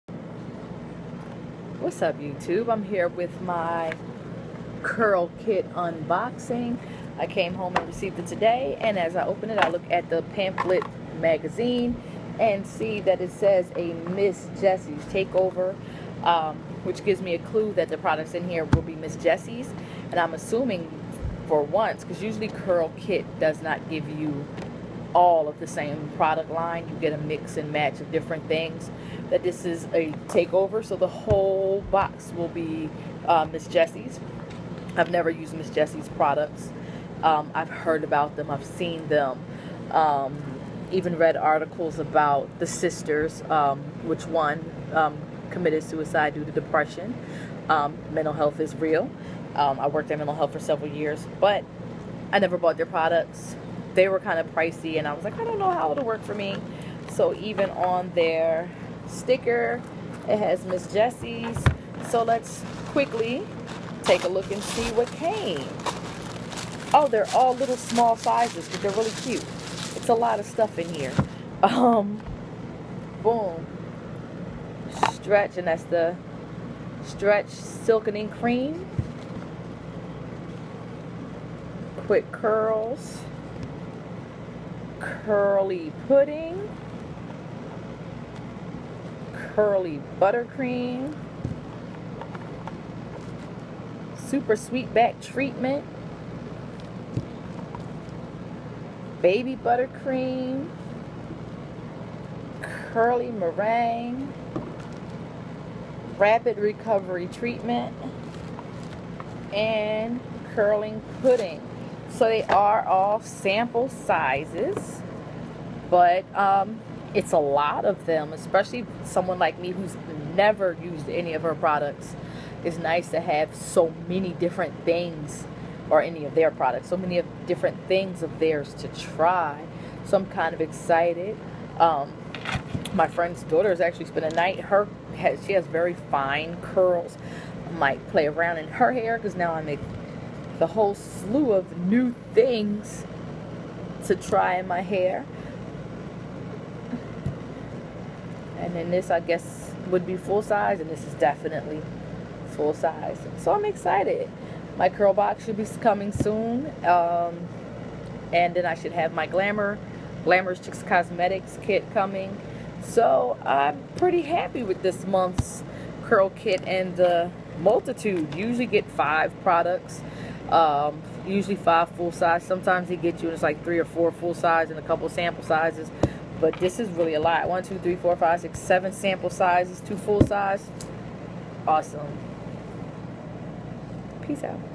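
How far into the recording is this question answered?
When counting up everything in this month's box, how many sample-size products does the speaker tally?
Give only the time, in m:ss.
2:58.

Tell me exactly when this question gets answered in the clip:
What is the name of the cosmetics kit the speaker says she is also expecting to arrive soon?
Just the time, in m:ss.
2:40.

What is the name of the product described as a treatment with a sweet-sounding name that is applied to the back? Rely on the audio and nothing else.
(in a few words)
Super sweet back treatment.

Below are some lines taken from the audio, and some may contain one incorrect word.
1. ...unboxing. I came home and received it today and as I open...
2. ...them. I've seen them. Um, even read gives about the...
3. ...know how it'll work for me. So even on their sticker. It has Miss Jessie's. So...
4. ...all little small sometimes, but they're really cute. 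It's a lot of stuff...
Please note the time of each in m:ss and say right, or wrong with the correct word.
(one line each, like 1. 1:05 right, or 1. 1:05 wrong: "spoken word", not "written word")
1. 0:05 right
2. 0:38 wrong: "articles", not "gives"
3. 0:55 right
4. 1:07 wrong: "sizes", not "sometimes".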